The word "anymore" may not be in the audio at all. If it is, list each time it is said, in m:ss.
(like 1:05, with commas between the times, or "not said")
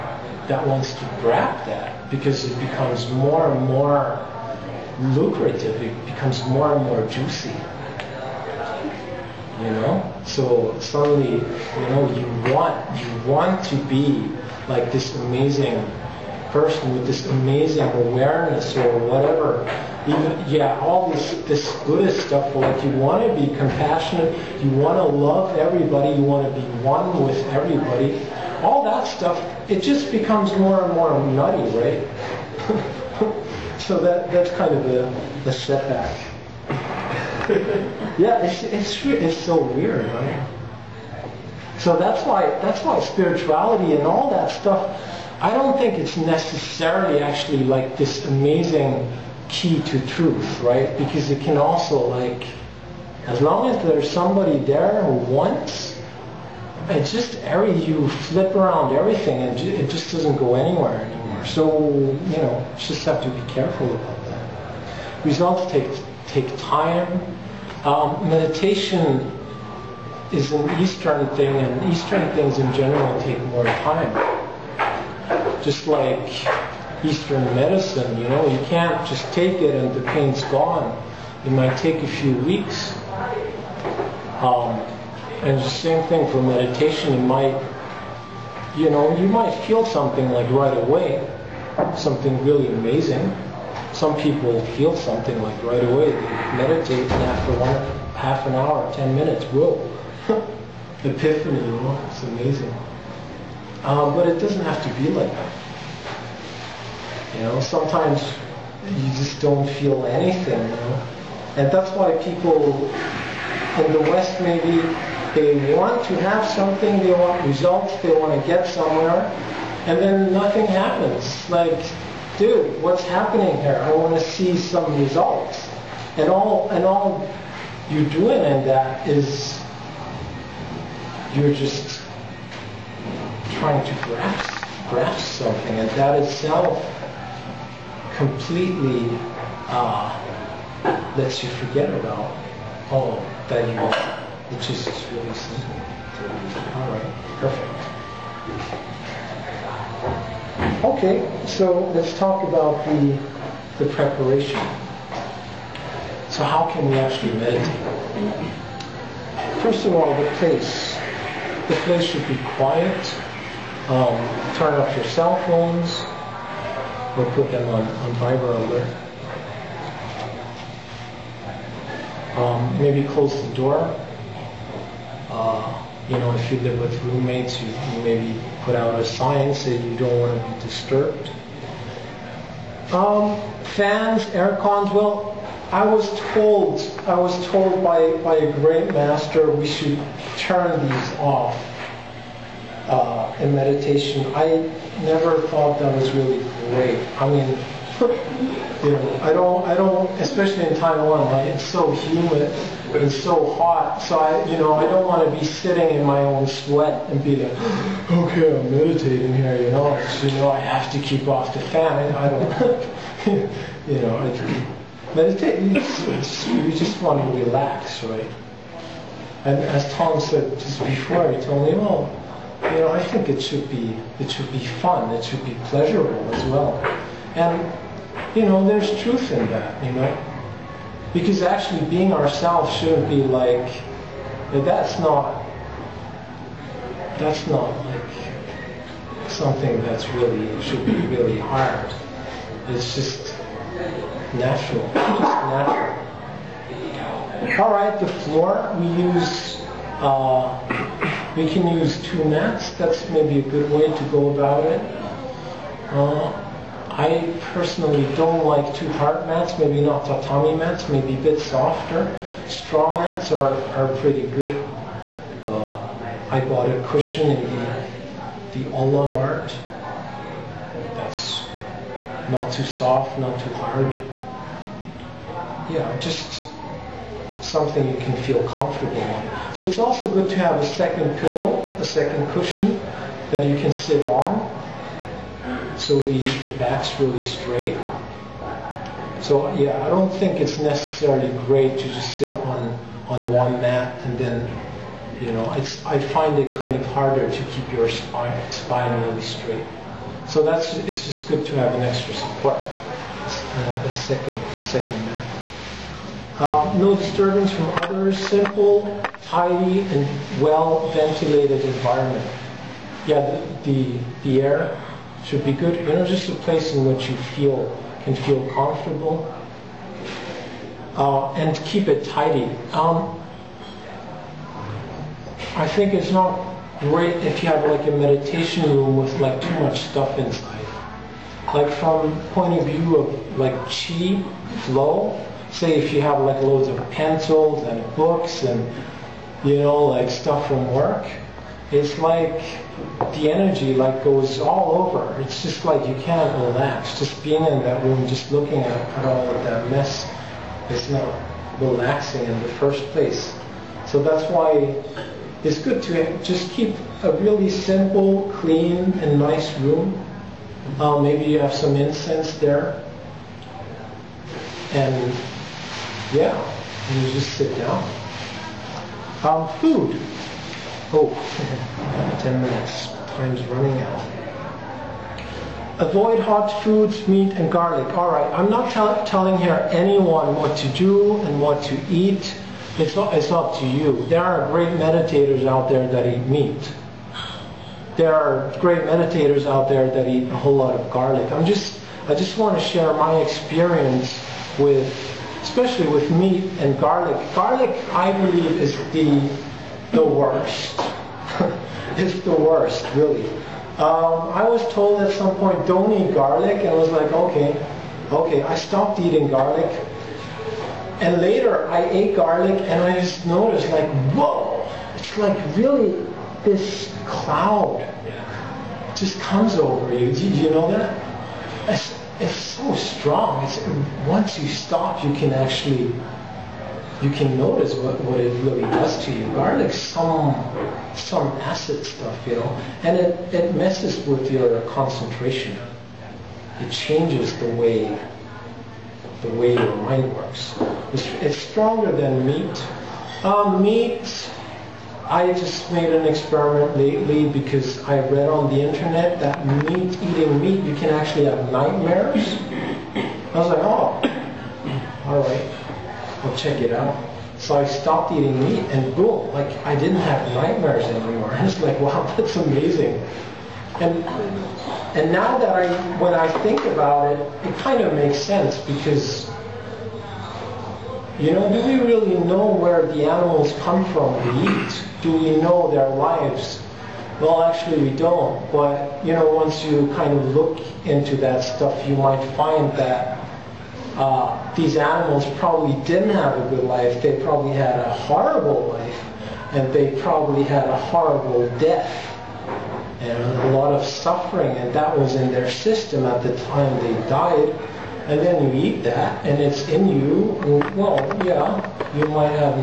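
1:01, 7:40.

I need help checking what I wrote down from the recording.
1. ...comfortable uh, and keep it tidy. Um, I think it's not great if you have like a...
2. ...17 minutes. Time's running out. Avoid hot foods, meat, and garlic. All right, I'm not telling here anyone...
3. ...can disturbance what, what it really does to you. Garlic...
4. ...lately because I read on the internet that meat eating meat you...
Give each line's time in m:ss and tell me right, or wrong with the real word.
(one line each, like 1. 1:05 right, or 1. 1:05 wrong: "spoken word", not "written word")
1. 5:18 right
2. 6:12 wrong: "10", not "17"
3. 7:07 wrong: "notice", not "disturbance"
4. 7:26 right.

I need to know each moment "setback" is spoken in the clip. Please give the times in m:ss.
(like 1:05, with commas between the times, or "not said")
0:35.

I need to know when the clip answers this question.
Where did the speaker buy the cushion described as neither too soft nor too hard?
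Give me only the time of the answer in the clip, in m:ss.
4:28.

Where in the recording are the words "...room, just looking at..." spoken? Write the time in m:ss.
5:47.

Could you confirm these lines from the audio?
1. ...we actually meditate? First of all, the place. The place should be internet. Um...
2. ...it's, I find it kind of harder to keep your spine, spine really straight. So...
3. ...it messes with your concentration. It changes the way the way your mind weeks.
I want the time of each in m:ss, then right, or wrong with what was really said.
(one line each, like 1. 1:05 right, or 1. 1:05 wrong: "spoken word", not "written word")
1. 2:36 wrong: "quiet", not "internet"
2. 4:55 right
3. 7:13 wrong: "works", not "weeks".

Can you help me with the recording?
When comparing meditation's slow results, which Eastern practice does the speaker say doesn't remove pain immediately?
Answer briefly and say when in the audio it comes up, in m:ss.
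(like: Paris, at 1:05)
Eastern medicine, at 1:17.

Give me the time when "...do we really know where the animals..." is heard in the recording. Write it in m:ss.
7:51.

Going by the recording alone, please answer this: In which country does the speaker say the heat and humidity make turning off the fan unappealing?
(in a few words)
Taiwan.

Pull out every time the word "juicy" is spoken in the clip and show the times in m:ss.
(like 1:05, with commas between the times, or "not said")
0:07.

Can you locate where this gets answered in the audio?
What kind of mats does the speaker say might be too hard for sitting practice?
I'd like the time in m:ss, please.
4:20.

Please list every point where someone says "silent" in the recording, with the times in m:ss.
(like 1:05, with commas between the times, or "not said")
not said.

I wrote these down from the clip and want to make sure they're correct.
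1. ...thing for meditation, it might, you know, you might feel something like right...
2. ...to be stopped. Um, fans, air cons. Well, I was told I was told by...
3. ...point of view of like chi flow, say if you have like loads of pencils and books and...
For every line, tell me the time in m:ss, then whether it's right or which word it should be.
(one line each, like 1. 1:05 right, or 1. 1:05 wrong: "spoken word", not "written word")
1. 1:26 right
2. 3:00 wrong: "disturbed", not "stopped"
3. 5:32 right.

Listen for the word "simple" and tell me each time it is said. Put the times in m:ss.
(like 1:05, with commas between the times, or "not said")
2:25, 5:08, 5:57.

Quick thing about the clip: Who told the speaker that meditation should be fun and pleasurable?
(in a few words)
Tom.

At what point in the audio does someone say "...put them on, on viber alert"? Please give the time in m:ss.
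2:47.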